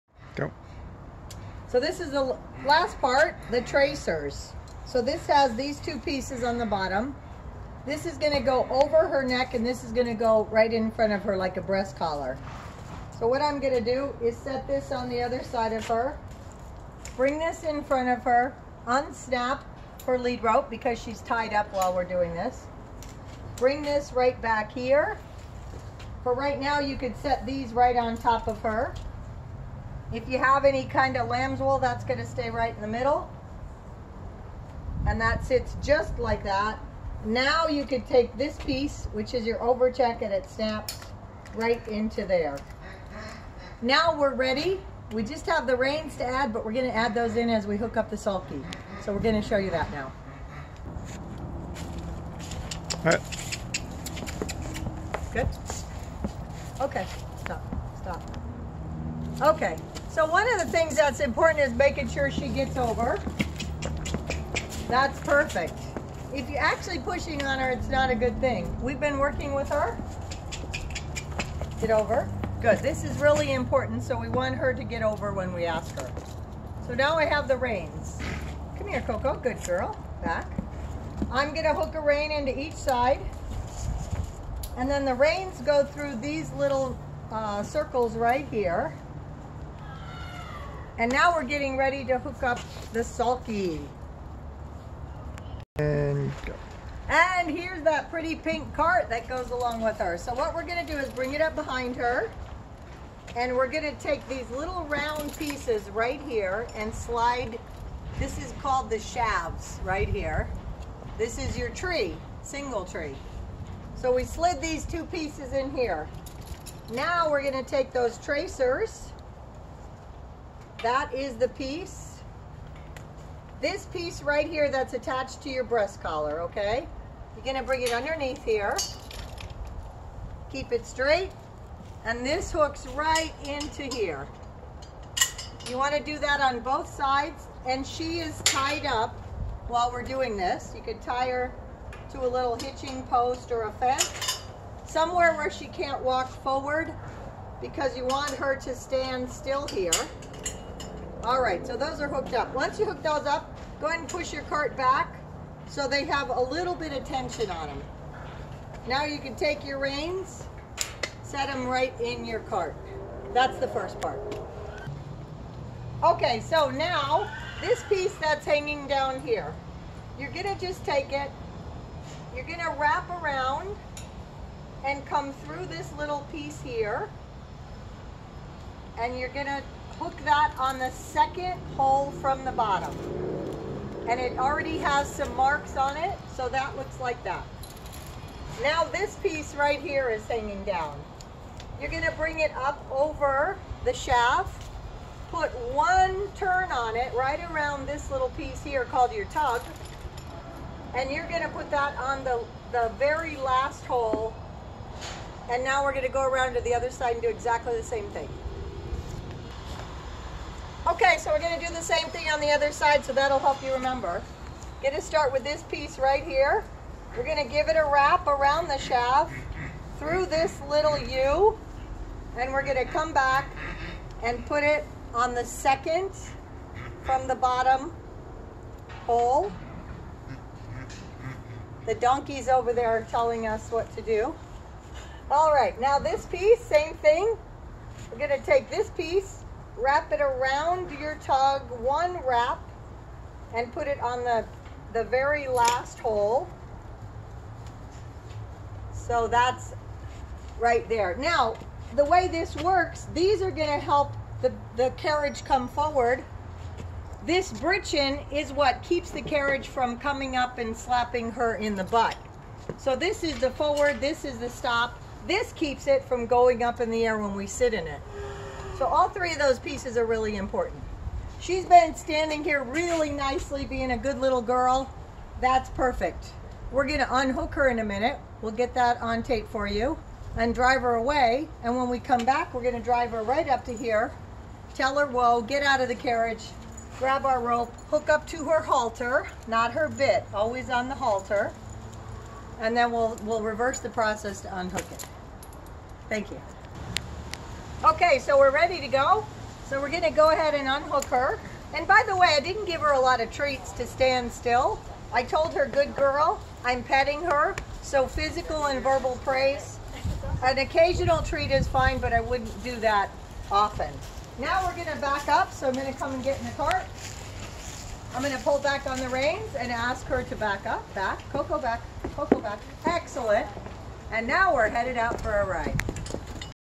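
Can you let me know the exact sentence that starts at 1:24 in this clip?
And then the reins go through these little uh, circles right here.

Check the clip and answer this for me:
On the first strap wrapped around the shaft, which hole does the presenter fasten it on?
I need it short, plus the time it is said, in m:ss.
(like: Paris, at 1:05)
Second from the bottom, at 3:00.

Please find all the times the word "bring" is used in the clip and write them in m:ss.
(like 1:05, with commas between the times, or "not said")
0:17, 0:23, 1:41, 2:07, 3:12.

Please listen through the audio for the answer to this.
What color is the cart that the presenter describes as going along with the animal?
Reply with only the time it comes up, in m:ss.
1:38.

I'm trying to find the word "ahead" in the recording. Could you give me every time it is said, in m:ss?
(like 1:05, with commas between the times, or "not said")
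2:33, 5:00.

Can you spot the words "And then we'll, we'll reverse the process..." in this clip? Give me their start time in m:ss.
4:52.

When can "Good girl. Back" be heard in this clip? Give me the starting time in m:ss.
1:19.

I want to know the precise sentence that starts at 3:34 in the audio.
Get to start with this piece right here.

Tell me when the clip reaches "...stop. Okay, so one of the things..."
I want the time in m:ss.
0:58.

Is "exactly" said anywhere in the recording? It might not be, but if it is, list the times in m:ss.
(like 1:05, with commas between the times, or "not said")
3:27.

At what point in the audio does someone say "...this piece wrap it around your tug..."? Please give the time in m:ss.
3:58.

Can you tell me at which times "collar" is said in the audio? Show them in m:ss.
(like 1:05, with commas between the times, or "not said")
0:11, 2:06.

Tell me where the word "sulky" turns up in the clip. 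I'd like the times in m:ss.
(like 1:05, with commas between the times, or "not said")
0:48, 1:33.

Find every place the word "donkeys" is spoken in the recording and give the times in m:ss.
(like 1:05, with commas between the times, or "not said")
3:51.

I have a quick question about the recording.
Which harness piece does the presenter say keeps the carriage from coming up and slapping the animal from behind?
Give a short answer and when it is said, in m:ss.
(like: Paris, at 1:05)
Britchin, at 4:17.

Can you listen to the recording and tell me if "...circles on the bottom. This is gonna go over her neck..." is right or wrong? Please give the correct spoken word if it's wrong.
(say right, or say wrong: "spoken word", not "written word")
wrong: "pieces", not "circles".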